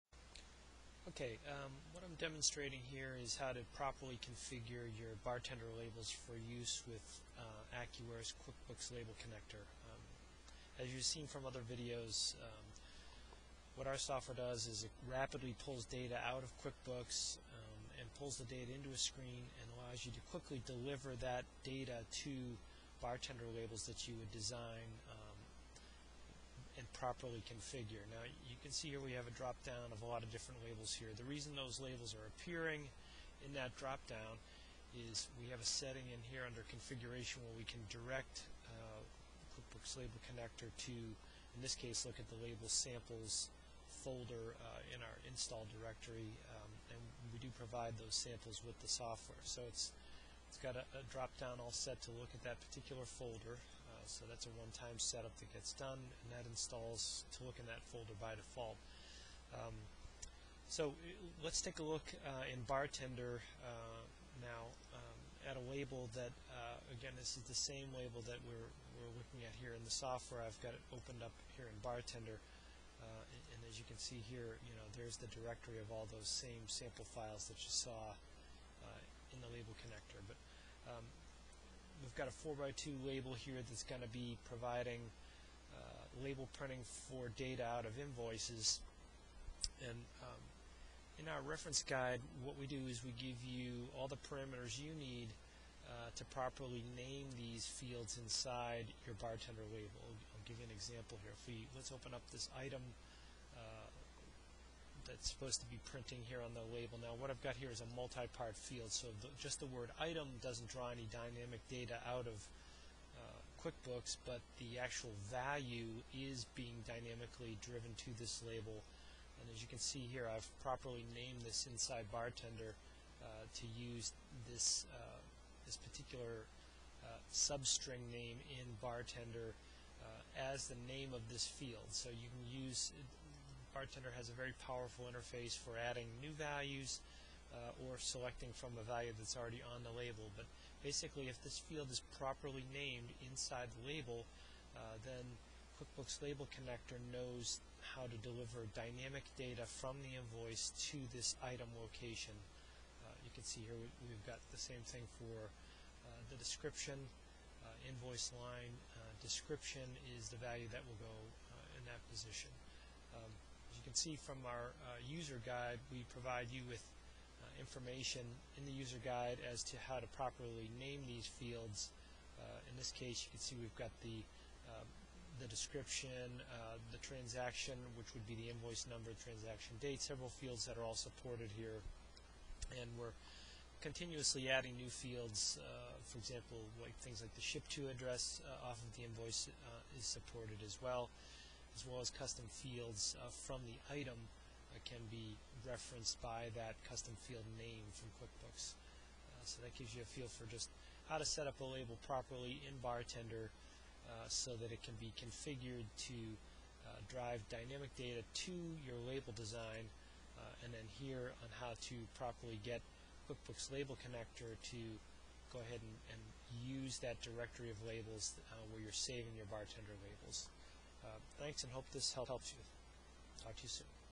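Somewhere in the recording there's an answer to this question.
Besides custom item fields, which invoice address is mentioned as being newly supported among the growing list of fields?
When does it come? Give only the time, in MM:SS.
03:07.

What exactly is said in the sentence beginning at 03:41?
Uh, thanks and hope this helps you.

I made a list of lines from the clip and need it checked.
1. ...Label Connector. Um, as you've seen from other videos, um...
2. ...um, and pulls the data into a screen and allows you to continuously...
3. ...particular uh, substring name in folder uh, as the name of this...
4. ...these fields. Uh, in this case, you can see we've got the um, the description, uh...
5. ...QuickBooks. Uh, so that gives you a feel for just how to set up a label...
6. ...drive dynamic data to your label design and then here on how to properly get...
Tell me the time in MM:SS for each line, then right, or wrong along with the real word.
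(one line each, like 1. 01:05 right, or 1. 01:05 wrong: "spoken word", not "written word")
1. 00:08 right
2. 00:17 wrong: "quickly", not "continuously"
3. 02:05 wrong: "bartender", not "folder"
4. 02:51 right
5. 03:18 right
6. 03:27 right.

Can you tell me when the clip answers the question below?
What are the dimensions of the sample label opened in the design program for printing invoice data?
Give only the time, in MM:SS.
01:22.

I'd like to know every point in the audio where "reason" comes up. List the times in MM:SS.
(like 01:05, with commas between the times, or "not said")
00:31.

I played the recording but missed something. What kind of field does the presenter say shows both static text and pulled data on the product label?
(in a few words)
Multi-part field.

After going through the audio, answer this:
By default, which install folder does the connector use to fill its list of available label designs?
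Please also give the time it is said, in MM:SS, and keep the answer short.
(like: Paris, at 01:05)
Label samples folder, at 00:42.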